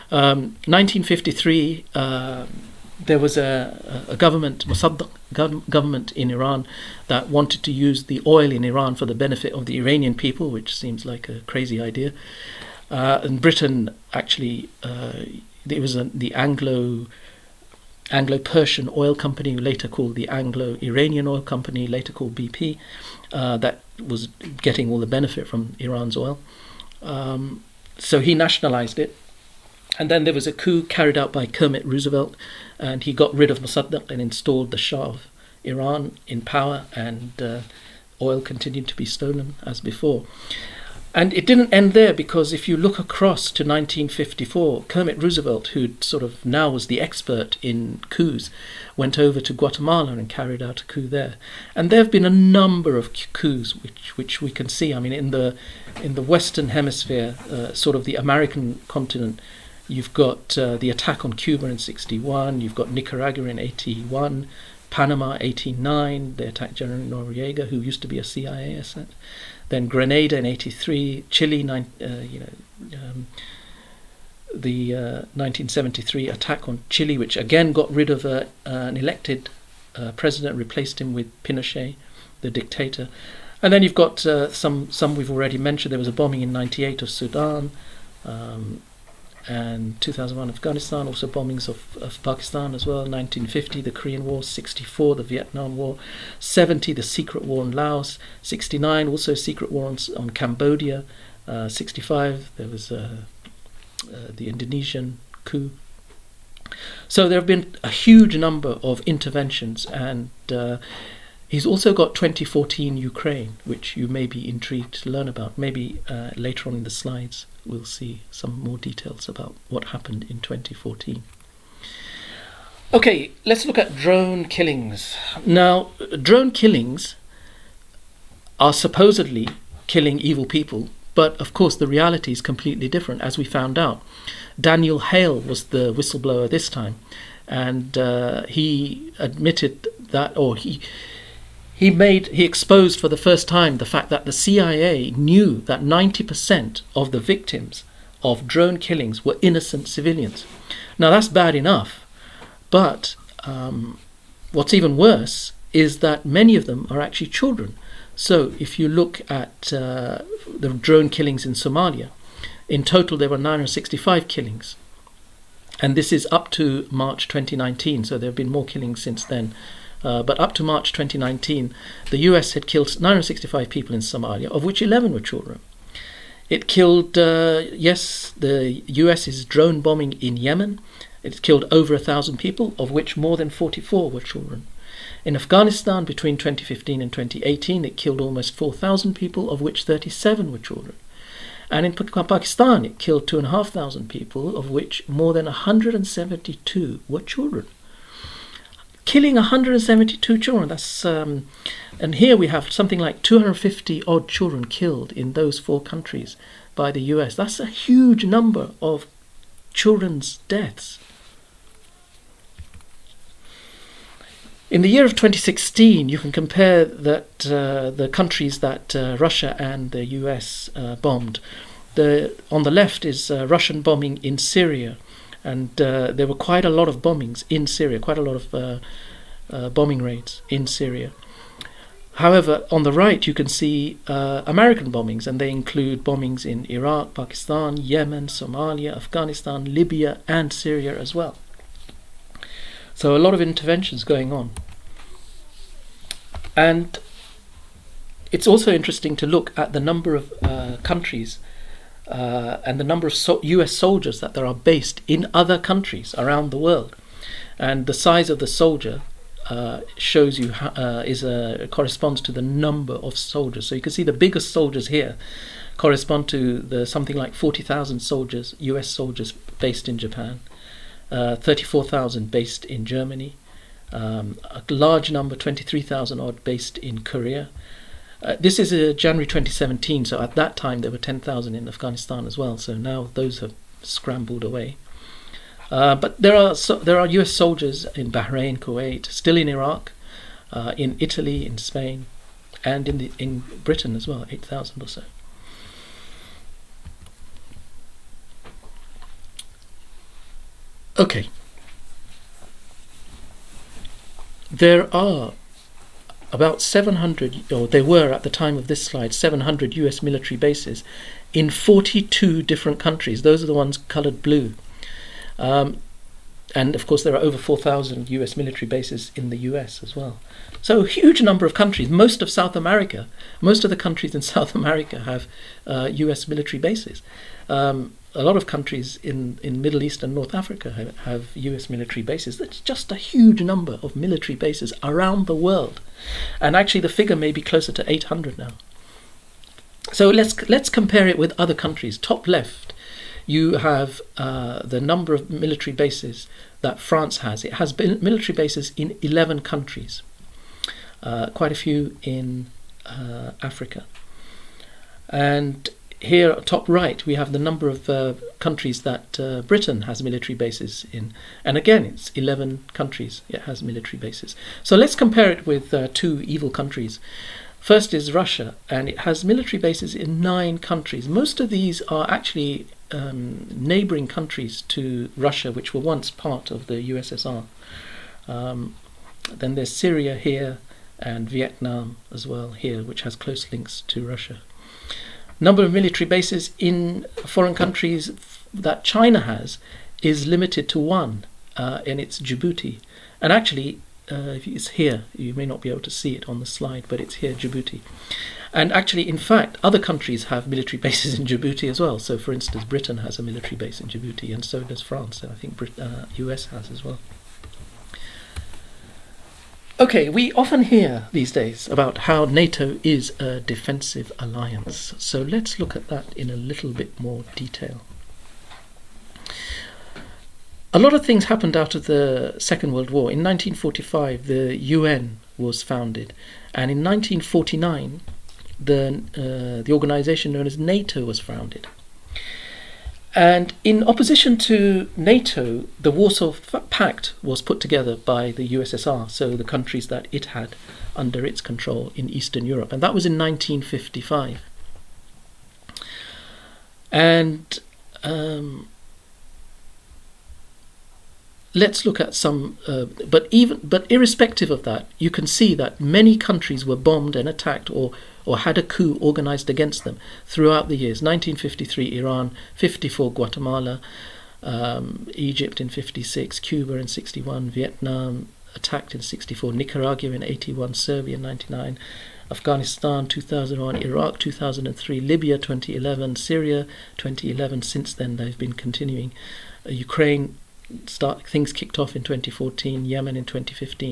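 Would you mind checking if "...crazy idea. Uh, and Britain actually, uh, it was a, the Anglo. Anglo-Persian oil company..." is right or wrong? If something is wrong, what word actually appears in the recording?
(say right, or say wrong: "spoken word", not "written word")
right.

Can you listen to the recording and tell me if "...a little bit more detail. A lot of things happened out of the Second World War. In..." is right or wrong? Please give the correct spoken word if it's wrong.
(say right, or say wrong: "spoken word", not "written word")
right.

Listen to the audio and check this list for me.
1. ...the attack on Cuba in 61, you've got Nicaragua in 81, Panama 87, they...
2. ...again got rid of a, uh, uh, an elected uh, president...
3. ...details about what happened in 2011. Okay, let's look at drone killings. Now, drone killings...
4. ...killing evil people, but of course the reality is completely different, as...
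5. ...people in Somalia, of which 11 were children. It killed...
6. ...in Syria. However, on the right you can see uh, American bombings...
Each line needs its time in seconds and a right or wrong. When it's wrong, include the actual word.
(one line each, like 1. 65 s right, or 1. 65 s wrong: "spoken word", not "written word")
1. 60 s wrong: "89", not "87"
2. 77 s right
3. 118 s wrong: "2014", not "2011"
4. 129 s right
5. 173 s right
6. 230 s right.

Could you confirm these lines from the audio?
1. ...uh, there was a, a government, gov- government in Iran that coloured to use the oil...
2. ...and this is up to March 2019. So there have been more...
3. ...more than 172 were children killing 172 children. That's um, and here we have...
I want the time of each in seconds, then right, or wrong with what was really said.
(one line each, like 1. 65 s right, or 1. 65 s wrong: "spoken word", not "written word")
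1. 1 s wrong: "wanted", not "coloured"
2. 165 s right
3. 195 s right.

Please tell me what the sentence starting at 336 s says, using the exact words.
And actually, the figure may be closer to 800 now.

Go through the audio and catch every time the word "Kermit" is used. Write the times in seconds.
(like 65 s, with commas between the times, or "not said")
31 s, 44 s.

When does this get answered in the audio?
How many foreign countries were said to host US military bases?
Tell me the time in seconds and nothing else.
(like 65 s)
311 s.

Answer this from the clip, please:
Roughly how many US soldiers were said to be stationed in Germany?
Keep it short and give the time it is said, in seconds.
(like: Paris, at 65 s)
34,000, at 271 s.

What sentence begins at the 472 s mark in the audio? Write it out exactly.
Afghanistan 2001, Iraq 2003, Libya 2011, Syria 2011.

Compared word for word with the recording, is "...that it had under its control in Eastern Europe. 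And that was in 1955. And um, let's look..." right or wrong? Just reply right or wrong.
right.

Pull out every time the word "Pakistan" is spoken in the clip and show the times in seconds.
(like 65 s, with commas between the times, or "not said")
92 s, 191 s, 237 s.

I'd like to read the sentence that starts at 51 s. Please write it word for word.
And there have been a number of coups which, which we can see.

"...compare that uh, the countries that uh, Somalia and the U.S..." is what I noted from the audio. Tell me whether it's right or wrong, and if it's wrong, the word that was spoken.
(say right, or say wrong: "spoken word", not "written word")
wrong: "Russia", not "Somalia".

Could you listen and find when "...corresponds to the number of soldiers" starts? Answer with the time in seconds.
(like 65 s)
261 s.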